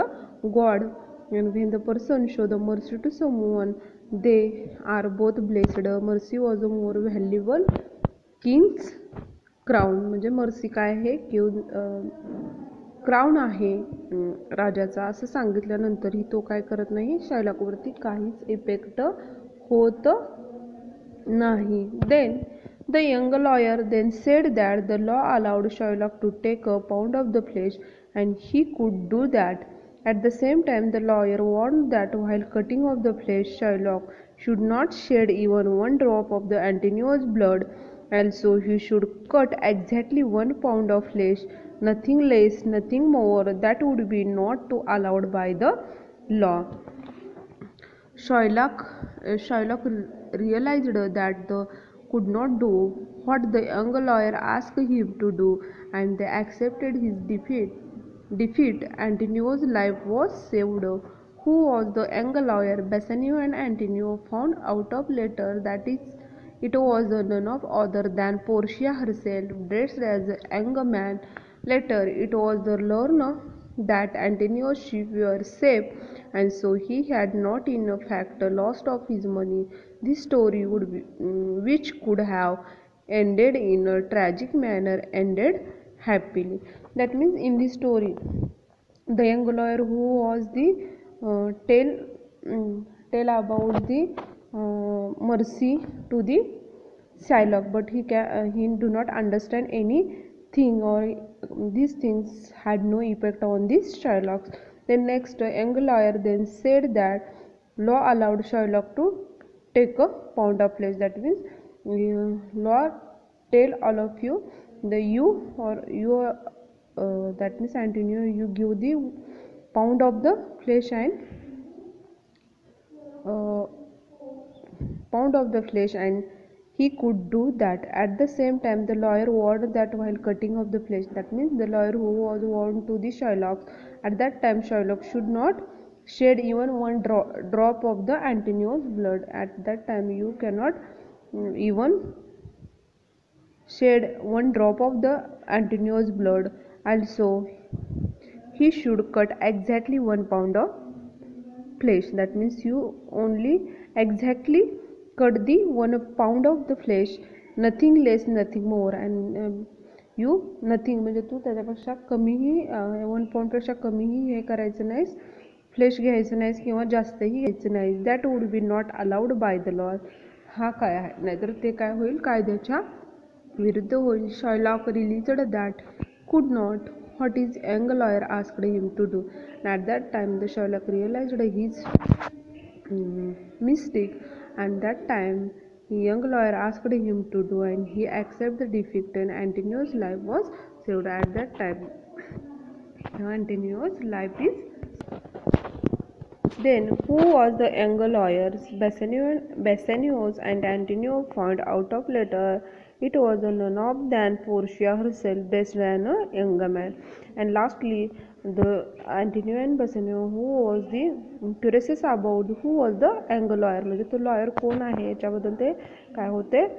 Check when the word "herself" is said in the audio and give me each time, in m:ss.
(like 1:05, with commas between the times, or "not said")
1:08, 3:24.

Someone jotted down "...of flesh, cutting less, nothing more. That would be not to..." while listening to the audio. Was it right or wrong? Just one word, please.
wrong.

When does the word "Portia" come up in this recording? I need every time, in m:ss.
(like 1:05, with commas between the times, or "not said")
1:08, 3:24.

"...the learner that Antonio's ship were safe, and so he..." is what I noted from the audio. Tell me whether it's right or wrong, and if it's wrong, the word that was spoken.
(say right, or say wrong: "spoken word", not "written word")
right.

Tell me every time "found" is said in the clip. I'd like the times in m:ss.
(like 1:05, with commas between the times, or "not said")
1:04, 3:21.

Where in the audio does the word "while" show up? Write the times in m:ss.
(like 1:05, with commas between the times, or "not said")
0:32, 2:10.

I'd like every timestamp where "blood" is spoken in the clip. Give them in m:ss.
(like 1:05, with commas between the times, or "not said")
0:37, 2:18, 2:26.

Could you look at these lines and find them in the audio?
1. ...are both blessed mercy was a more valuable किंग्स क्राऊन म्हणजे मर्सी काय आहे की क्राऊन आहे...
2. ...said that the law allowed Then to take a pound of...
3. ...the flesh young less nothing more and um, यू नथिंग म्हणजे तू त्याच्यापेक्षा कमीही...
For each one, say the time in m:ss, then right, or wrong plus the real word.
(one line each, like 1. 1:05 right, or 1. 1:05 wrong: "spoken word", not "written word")
1. 0:04 right
2. 0:24 wrong: "Shylock", not "Then"
3. 2:36 wrong: "nothing", not "young".